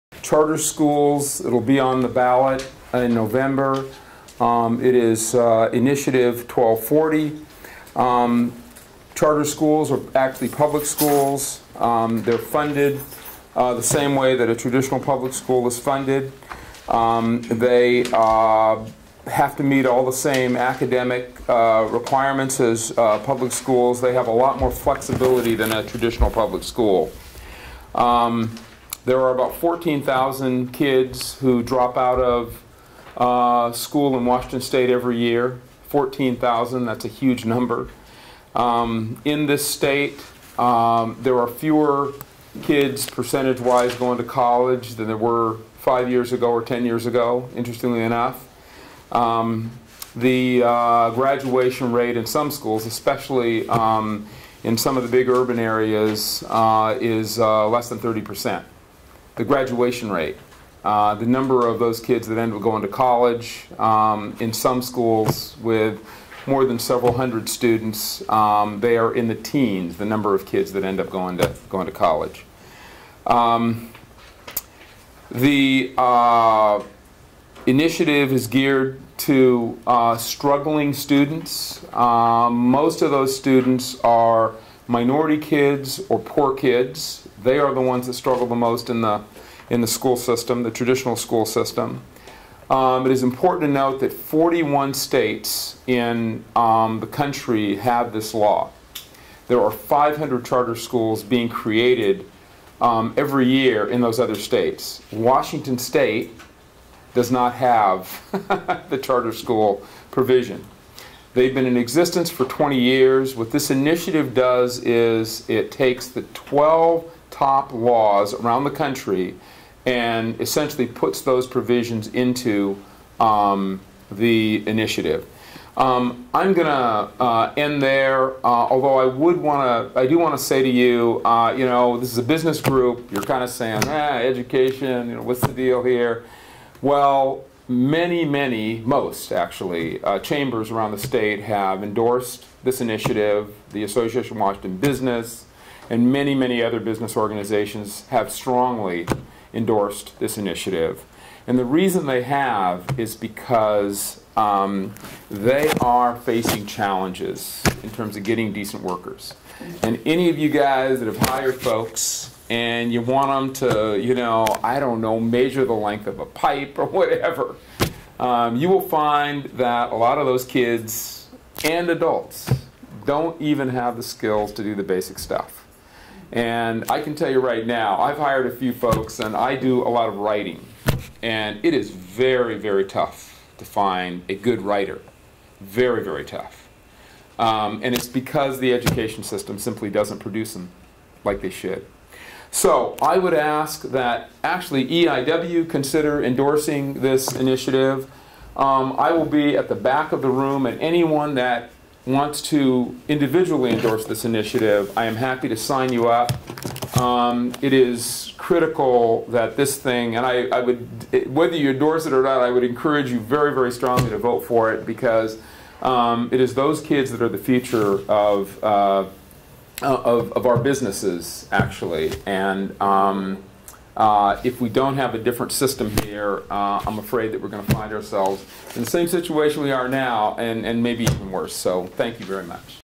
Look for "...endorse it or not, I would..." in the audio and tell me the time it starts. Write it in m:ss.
3:31.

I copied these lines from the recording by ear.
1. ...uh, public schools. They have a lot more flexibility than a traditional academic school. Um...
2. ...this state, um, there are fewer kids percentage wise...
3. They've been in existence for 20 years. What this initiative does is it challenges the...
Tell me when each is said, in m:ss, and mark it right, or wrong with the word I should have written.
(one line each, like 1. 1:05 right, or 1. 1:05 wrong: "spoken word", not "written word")
1. 0:22 wrong: "public", not "academic"
2. 0:39 right
3. 1:51 wrong: "takes", not "challenges".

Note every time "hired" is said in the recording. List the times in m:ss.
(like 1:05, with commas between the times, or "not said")
2:41, 2:58.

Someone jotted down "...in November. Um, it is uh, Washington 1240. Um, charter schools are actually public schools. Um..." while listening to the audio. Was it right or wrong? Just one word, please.
wrong.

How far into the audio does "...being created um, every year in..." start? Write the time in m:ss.
1:41.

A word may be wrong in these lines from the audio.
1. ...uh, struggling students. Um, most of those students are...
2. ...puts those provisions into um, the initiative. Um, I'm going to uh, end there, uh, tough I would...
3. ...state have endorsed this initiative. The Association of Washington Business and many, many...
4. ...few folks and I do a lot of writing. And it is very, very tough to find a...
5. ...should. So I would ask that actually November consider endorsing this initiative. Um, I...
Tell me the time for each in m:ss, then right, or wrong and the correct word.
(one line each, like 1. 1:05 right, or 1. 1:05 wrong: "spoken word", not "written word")
1. 1:19 right
2. 2:00 wrong: "although", not "tough"
3. 2:20 right
4. 2:58 right
5. 3:11 wrong: "EIW", not "November".